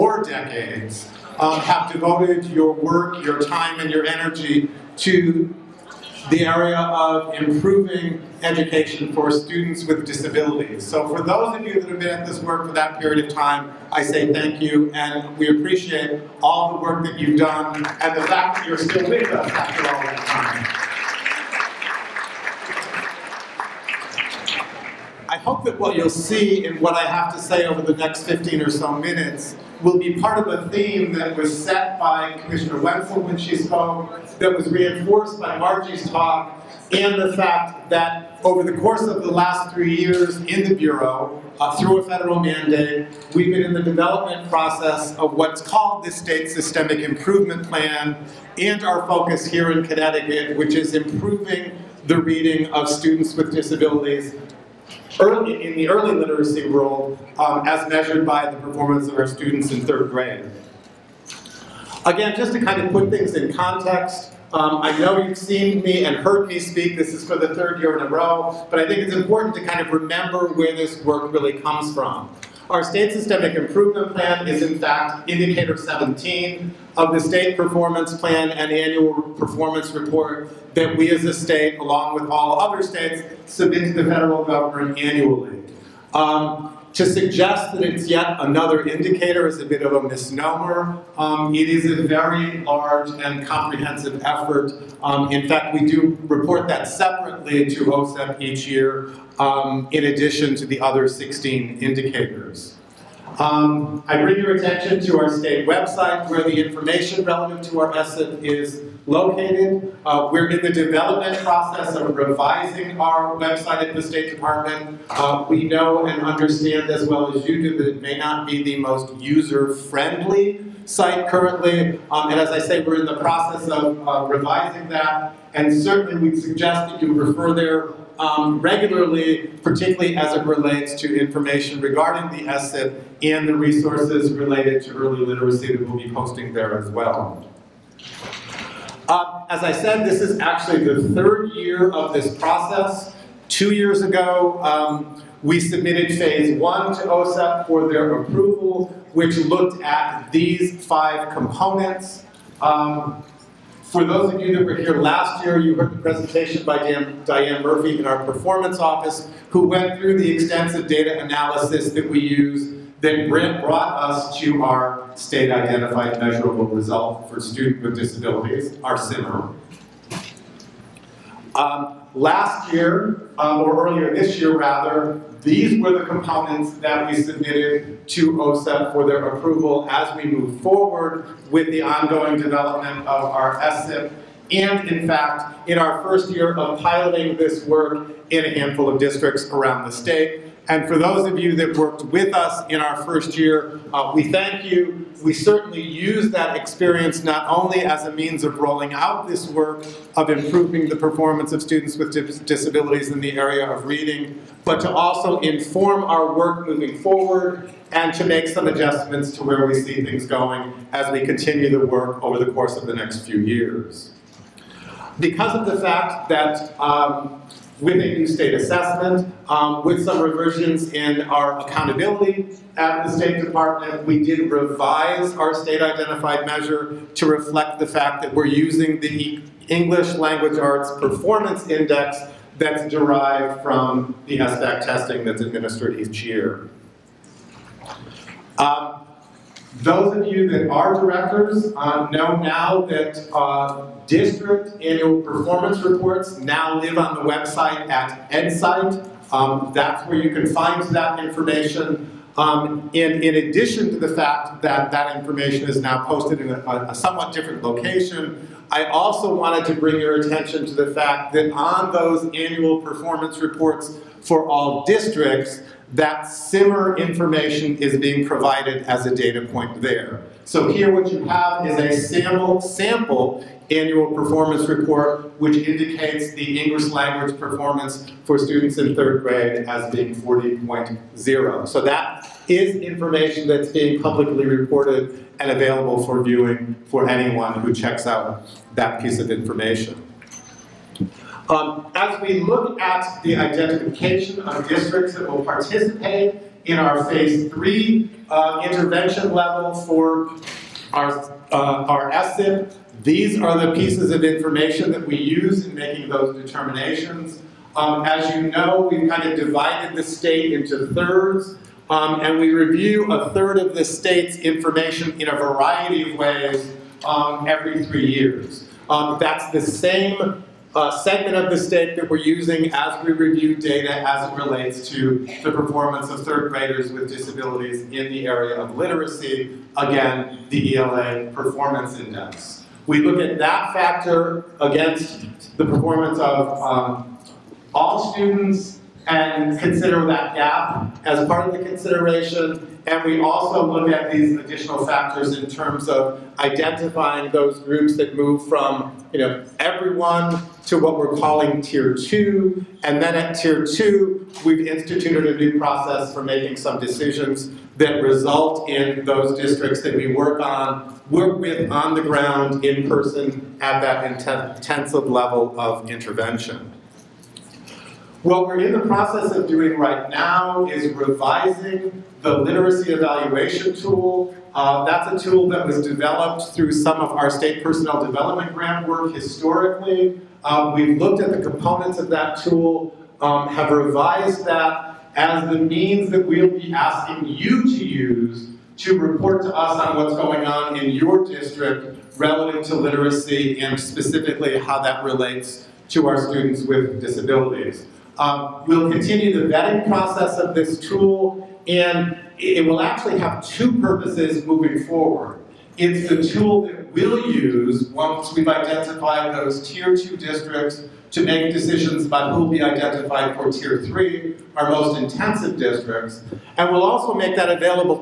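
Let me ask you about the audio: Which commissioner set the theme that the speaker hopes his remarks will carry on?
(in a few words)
Commissioner Wentzell.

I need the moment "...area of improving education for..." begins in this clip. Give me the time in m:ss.
0:06.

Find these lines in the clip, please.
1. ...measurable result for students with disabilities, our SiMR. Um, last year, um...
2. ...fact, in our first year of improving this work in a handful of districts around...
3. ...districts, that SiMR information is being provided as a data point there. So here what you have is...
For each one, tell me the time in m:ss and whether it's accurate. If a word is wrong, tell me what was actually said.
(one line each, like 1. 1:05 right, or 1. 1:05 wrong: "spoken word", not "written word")
1. 2:46 right
2. 3:05 wrong: "piloting", not "improving"
3. 4:24 right.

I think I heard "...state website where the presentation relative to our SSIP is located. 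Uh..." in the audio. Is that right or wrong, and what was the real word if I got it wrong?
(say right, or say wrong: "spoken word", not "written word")
wrong: "information", not "presentation".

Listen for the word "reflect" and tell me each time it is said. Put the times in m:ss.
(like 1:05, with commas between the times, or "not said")
3:47.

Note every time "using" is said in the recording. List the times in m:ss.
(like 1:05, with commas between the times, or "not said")
3:48, 5:22.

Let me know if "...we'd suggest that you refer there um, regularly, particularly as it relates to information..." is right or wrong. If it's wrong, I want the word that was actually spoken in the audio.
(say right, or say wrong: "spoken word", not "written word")
right.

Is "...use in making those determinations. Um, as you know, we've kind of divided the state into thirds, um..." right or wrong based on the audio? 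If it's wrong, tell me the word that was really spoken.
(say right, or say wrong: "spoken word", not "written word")
right.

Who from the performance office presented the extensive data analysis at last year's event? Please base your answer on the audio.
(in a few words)
Diane Murphy.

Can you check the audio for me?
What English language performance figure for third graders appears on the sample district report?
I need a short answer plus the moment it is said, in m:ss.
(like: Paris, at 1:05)
40.0, at 4:40.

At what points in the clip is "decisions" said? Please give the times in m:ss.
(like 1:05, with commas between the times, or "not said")
5:56, 6:51.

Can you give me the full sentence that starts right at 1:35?
Um, in fact, we do report that separately to OSEP each year um, in addition to the other 16 indicators.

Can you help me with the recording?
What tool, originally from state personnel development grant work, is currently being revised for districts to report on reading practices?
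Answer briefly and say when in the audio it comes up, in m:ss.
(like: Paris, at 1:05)
literacy evaluation tool, at 6:12.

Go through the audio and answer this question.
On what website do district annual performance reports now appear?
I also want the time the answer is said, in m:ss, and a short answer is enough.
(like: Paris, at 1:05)
EdSight, at 4:08.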